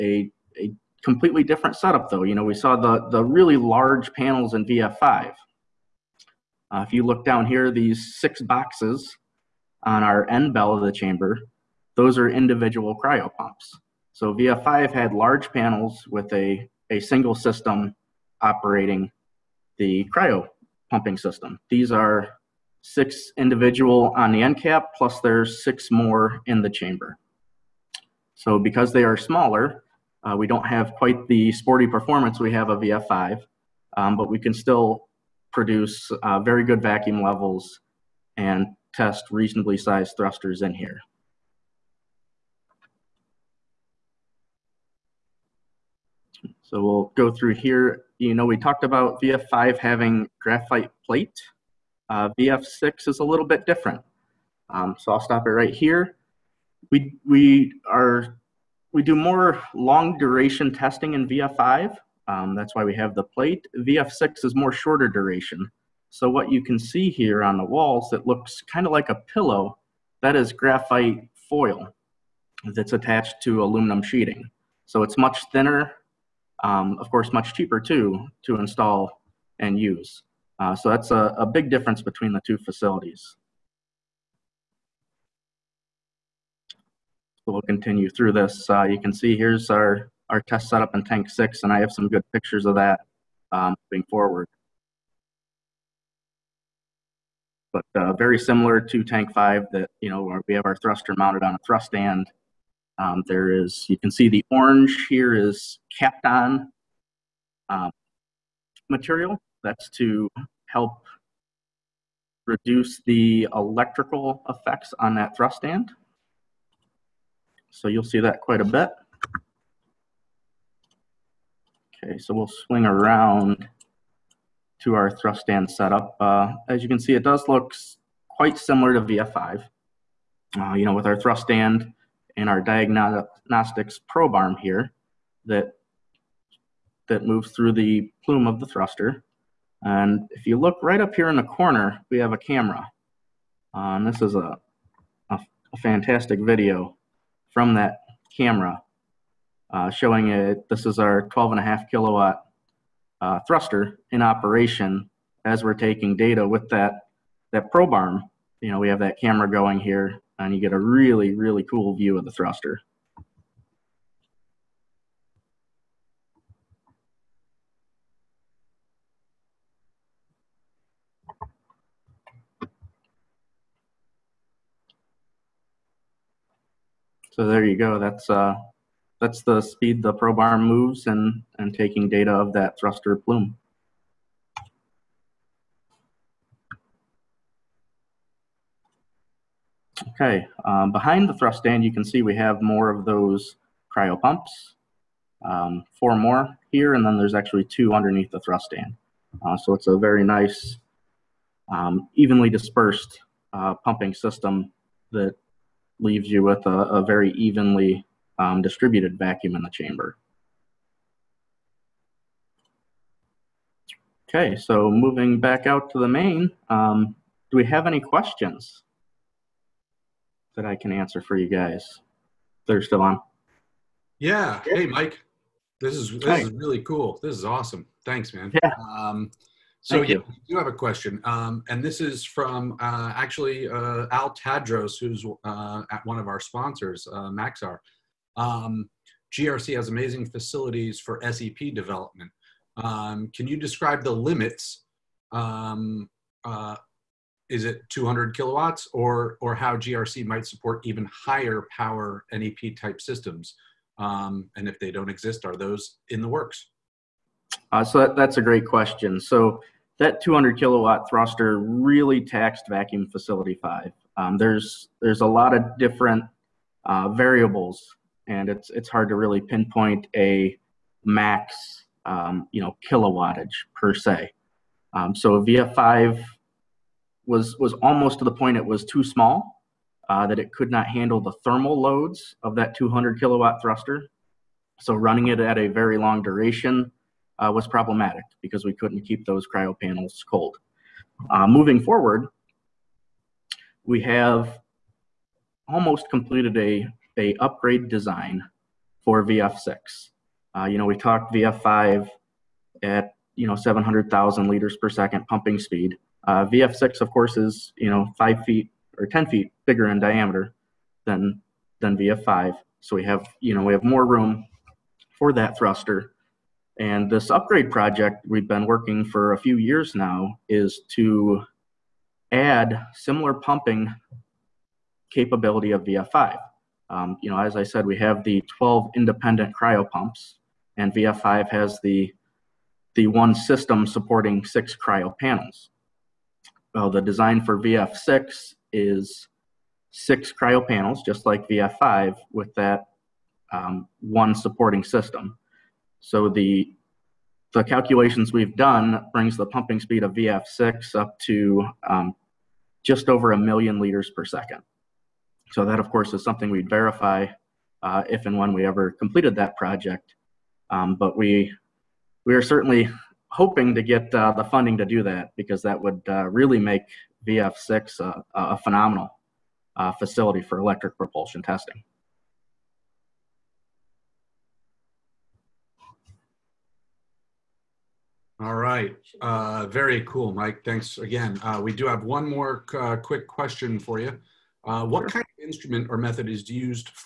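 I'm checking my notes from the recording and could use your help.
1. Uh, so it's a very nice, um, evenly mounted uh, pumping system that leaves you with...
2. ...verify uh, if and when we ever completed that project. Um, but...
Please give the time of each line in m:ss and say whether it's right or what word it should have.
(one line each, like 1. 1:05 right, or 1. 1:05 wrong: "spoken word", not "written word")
1. 3:19 wrong: "dispersed", not "mounted"
2. 5:56 right.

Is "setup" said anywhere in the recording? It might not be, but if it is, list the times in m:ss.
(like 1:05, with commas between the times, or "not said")
0:01, 1:30, 2:05.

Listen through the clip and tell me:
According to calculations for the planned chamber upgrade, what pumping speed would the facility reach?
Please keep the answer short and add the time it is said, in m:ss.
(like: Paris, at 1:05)
just over 1 million liters per second, at 5:52.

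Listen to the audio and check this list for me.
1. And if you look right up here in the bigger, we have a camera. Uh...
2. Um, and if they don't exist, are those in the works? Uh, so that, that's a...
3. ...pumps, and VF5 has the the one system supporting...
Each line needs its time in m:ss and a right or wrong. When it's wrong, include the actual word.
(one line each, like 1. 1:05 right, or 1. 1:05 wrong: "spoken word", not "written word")
1. 2:19 wrong: "corner", not "bigger"
2. 4:13 right
3. 5:29 right.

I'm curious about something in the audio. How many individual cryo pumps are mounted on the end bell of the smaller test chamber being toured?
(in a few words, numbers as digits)
6.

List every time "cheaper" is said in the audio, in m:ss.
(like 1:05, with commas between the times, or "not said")
1:17.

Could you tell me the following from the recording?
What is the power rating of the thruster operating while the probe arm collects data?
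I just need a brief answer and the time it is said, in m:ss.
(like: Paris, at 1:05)
12.5 kilowatts, at 2:31.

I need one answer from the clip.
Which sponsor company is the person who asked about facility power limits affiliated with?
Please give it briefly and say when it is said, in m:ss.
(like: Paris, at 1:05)
Maxar, at 3:57.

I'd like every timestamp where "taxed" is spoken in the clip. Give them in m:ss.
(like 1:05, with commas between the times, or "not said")
4:22.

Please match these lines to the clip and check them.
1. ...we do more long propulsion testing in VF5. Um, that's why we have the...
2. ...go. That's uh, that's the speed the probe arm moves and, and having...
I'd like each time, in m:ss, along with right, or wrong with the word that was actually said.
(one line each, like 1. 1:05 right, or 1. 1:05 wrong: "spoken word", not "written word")
1. 0:58 wrong: "duration", not "propulsion"
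2. 2:57 wrong: "taking", not "having".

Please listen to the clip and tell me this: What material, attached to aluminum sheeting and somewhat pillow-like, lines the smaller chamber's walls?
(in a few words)
graphite foil.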